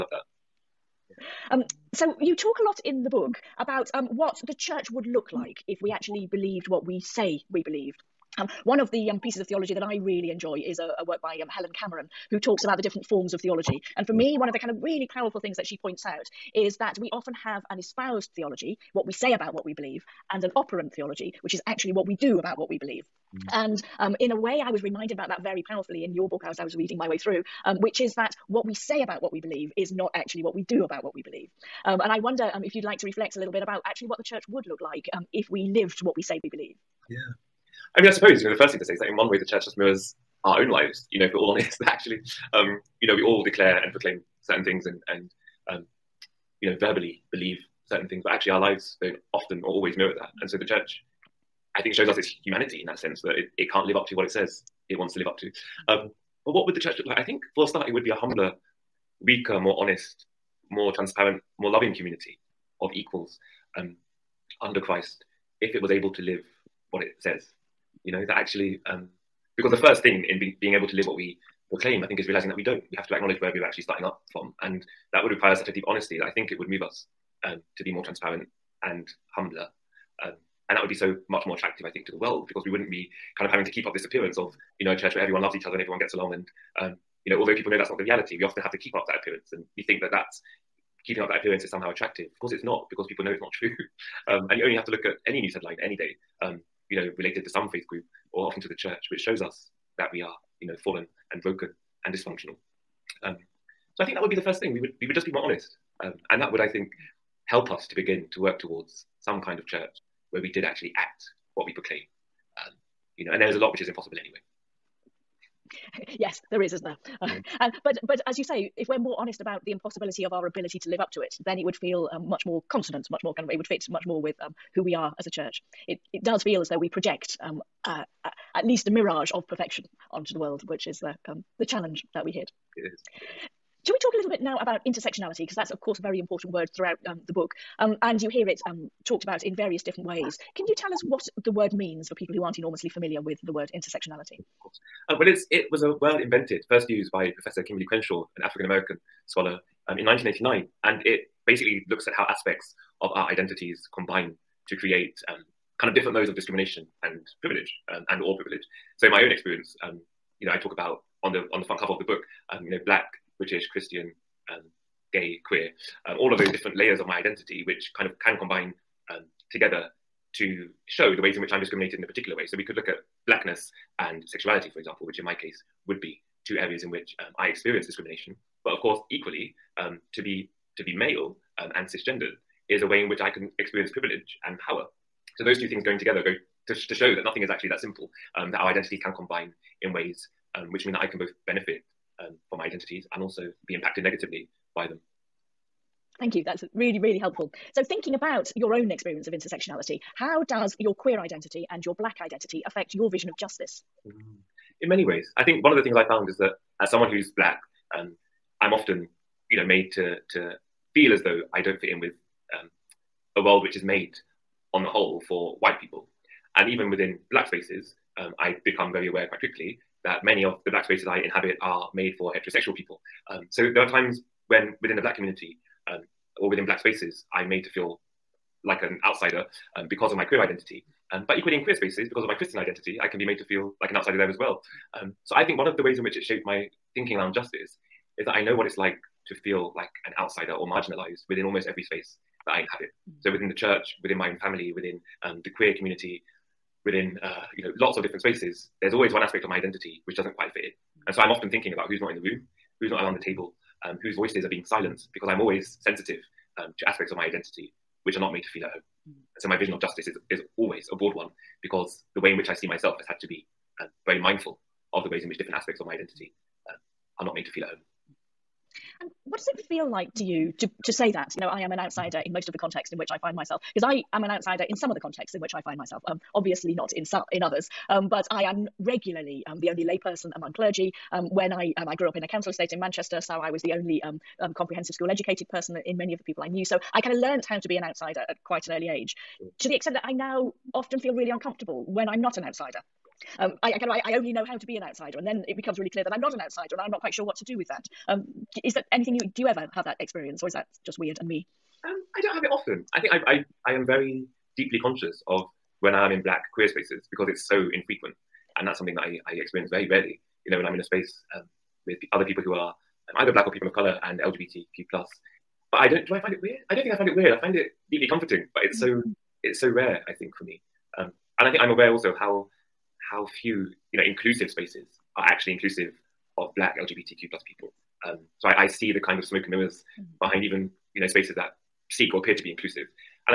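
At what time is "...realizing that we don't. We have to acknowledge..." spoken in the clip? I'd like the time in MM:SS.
01:12.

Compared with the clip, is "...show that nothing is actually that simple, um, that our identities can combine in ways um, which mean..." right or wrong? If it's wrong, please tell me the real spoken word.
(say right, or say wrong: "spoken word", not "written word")
right.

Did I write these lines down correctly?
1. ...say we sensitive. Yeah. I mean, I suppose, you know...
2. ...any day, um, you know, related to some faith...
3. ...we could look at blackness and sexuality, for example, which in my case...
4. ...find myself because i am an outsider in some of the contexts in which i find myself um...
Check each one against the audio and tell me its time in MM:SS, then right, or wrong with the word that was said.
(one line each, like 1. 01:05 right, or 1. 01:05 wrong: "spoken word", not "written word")
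1. 00:36 wrong: "believe", not "sensitive"
2. 01:35 right
3. 02:52 right
4. 04:33 right.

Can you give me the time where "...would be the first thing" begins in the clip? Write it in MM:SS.
01:44.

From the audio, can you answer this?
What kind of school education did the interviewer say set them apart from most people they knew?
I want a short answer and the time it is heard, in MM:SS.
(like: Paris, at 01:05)
Comprehensive school, at 04:44.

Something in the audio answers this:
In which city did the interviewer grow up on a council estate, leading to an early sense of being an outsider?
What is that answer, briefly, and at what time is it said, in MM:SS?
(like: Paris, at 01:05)
Manchester, at 04:42.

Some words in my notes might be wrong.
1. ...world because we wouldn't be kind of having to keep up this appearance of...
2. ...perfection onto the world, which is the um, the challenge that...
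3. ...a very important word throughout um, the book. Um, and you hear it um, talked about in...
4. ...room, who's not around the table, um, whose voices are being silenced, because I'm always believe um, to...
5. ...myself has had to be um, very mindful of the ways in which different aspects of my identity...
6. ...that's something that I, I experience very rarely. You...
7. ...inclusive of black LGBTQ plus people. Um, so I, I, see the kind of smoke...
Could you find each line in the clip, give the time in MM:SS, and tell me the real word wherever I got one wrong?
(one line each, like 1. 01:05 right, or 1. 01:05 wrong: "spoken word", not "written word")
1. 01:22 right
2. 02:09 right
3. 02:15 right
4. 04:12 wrong: "sensitive", not "believe"
5. 04:22 right
6. 05:08 right
7. 05:25 right.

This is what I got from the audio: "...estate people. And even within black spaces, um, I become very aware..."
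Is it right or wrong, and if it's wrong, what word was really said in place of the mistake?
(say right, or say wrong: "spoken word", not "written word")
wrong: "white", not "estate".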